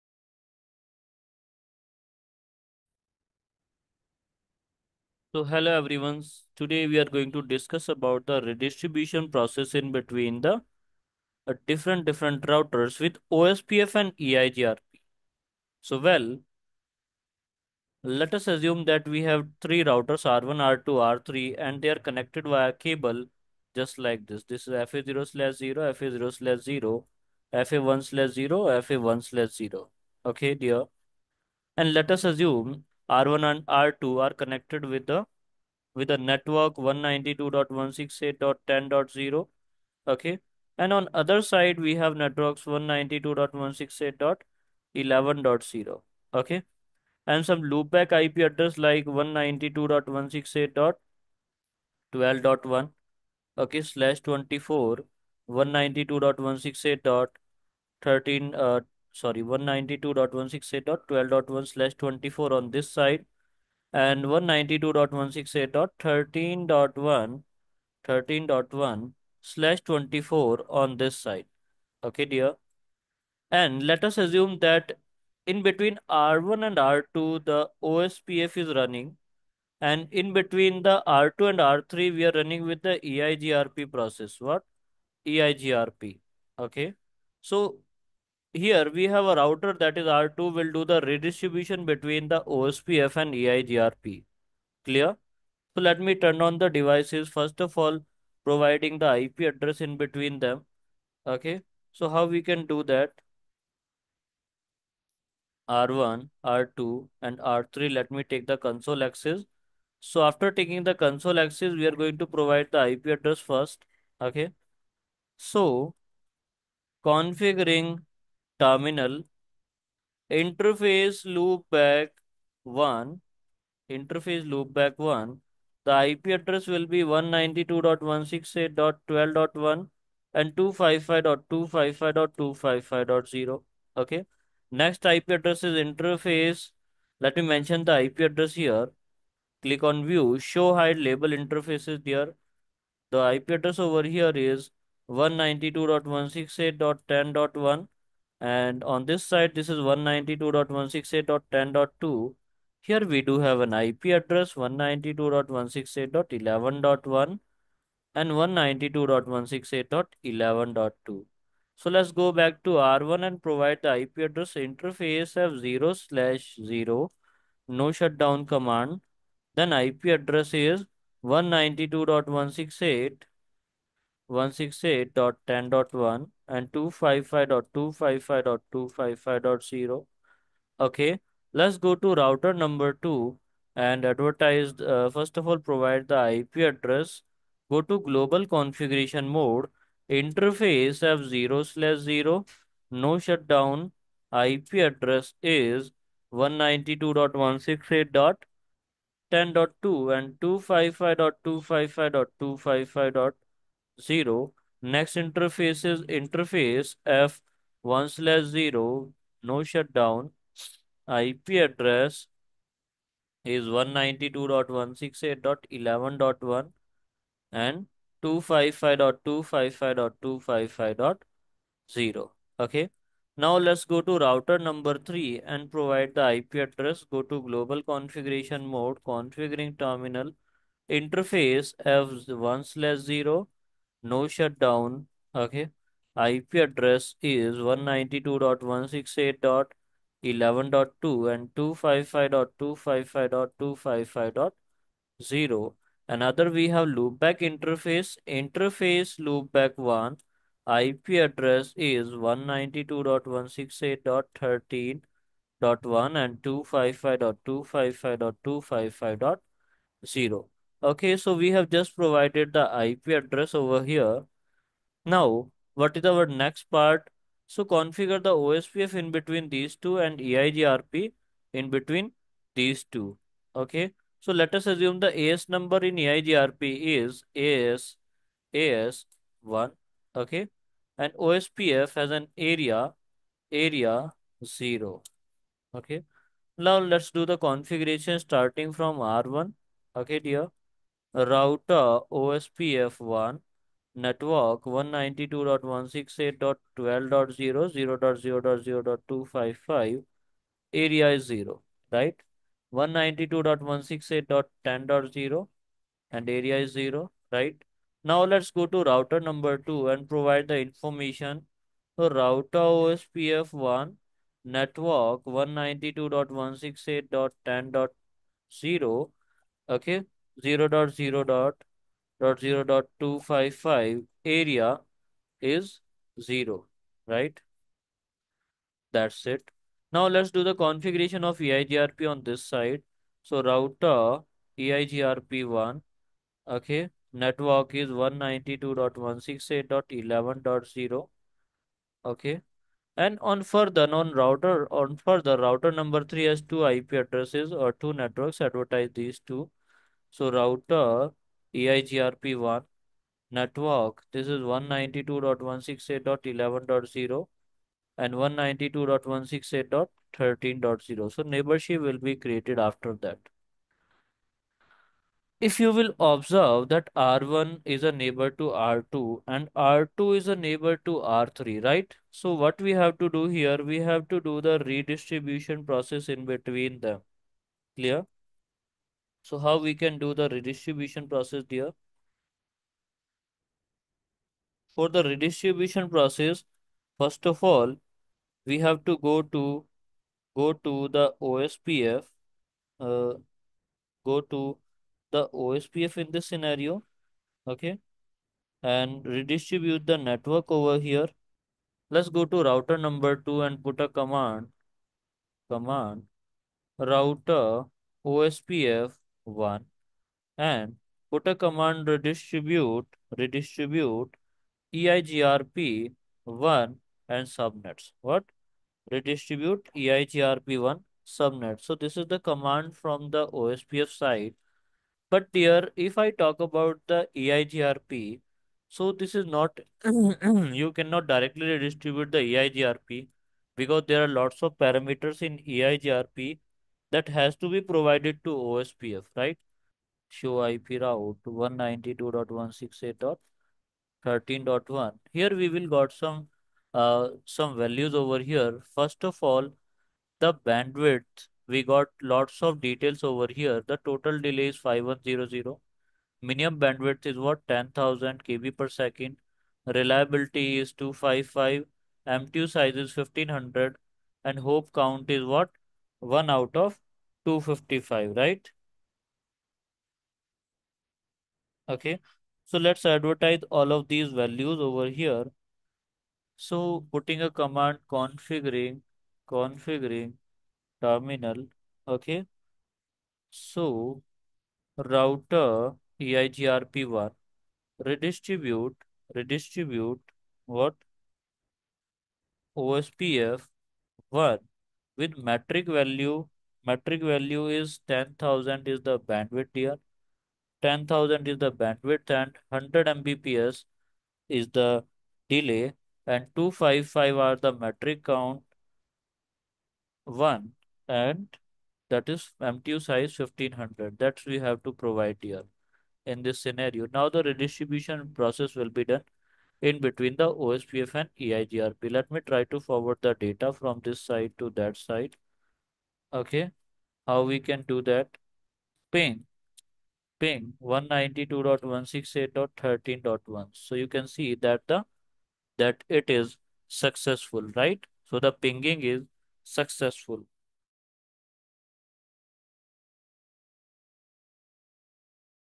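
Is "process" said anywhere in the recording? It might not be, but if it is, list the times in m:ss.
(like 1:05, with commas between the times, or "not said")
0:09, 1:23, 6:15, 6:21, 6:25, 8:38.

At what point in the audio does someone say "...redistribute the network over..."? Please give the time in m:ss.
6:39.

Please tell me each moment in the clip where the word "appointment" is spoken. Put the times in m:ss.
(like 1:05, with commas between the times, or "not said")
not said.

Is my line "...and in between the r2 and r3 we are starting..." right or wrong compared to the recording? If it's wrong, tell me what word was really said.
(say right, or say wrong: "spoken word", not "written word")
wrong: "running", not "starting".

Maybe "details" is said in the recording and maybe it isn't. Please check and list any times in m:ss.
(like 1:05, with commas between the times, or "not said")
7:32.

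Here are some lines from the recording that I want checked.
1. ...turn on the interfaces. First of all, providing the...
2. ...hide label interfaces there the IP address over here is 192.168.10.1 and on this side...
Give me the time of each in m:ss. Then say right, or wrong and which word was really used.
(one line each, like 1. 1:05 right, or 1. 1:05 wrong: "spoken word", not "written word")
1. 1:36 wrong: "devices", not "interfaces"
2. 2:20 right.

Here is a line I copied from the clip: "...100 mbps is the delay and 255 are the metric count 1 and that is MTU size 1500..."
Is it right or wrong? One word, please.
right.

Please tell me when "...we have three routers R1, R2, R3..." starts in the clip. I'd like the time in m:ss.
0:19.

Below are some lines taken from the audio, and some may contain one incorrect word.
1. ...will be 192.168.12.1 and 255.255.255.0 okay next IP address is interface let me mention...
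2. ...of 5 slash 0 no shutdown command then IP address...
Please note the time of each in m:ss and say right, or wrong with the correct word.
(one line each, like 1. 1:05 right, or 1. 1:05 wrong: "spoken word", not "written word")
1. 2:06 right
2. 2:45 wrong: "0", not "5".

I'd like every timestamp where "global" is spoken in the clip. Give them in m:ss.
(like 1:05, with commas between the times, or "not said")
3:07, 3:47.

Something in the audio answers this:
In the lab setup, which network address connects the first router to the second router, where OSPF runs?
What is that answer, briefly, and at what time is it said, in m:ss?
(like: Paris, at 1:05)
192.168.10.0, at 0:36.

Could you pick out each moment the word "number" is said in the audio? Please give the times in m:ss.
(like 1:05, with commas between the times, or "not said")
3:02, 3:44, 4:35, 5:45, 6:42.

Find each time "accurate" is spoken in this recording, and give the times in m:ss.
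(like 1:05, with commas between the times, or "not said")
not said.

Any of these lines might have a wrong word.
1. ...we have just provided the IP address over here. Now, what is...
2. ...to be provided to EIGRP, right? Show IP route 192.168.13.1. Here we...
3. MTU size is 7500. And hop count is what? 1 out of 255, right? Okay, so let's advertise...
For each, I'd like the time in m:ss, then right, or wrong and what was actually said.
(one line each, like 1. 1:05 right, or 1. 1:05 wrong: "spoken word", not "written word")
1. 4:21 right
2. 7:17 wrong: "OSPF", not "EIGRP"
3. 7:42 wrong: "1500", not "7500".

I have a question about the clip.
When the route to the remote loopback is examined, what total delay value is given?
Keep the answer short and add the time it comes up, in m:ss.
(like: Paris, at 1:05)
5100, at 7:34.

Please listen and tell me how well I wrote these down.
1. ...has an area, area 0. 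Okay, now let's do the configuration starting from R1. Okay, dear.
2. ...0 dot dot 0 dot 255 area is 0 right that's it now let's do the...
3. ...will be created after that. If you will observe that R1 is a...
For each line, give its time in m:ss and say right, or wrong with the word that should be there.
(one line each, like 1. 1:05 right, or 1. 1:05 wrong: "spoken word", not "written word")
1. 4:41 right
2. 5:20 right
3. 6:01 right.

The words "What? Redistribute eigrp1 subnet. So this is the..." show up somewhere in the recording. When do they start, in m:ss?
6:58.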